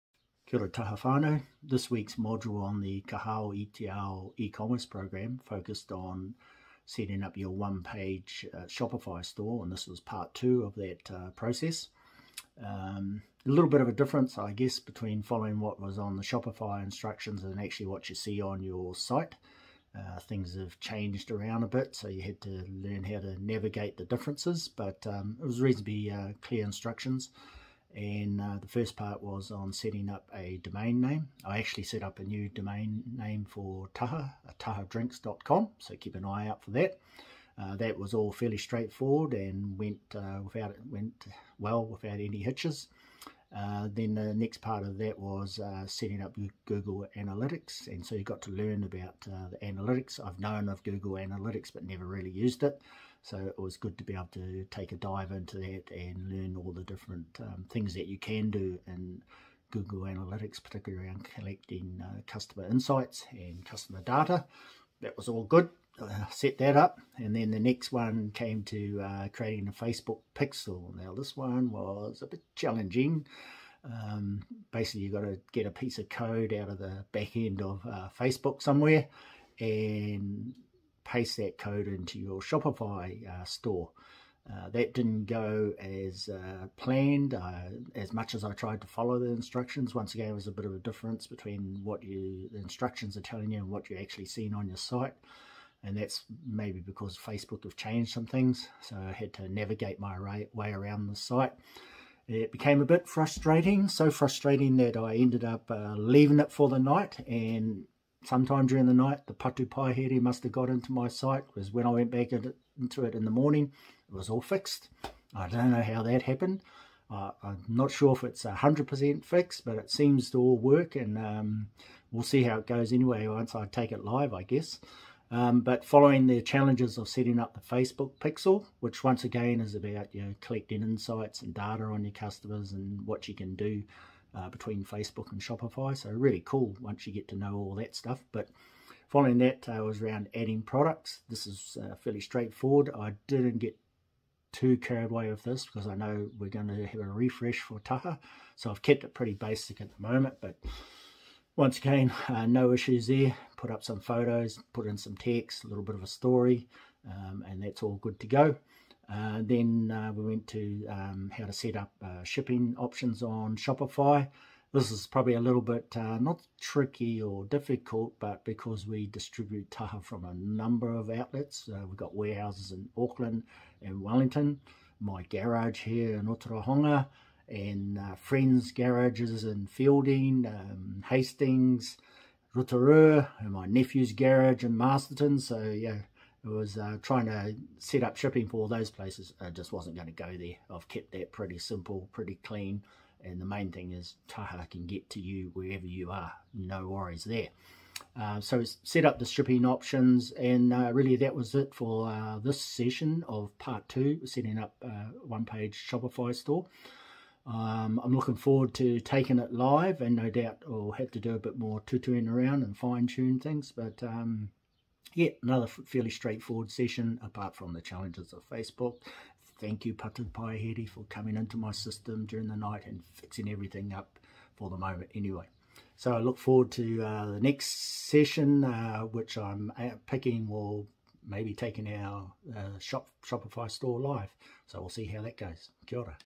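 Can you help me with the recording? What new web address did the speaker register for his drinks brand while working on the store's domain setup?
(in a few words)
tahadrinks.com.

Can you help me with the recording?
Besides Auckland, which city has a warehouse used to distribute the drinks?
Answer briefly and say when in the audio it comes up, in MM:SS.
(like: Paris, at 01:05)
Wellington, at 02:54.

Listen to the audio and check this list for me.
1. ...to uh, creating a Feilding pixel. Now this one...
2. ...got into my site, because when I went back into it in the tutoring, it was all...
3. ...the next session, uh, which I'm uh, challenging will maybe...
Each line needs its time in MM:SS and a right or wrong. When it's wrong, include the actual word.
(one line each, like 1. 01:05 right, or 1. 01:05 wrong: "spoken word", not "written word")
1. 01:08 wrong: "Facebook", not "Feilding"
2. 01:50 wrong: "morning", not "tutoring"
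3. 03:47 wrong: "picking", not "challenging".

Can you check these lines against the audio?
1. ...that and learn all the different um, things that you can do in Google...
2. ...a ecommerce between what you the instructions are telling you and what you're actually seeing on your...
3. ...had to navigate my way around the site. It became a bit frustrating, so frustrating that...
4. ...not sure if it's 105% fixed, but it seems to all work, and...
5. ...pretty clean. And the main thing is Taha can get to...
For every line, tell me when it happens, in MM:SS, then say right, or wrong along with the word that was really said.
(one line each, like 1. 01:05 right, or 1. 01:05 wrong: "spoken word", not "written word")
1. 00:55 right
2. 01:30 wrong: "difference", not "ecommerce"
3. 01:39 right
4. 01:57 wrong: "100", not "105"
5. 03:12 right.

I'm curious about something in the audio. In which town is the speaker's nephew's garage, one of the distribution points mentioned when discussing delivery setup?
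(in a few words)
Masterton.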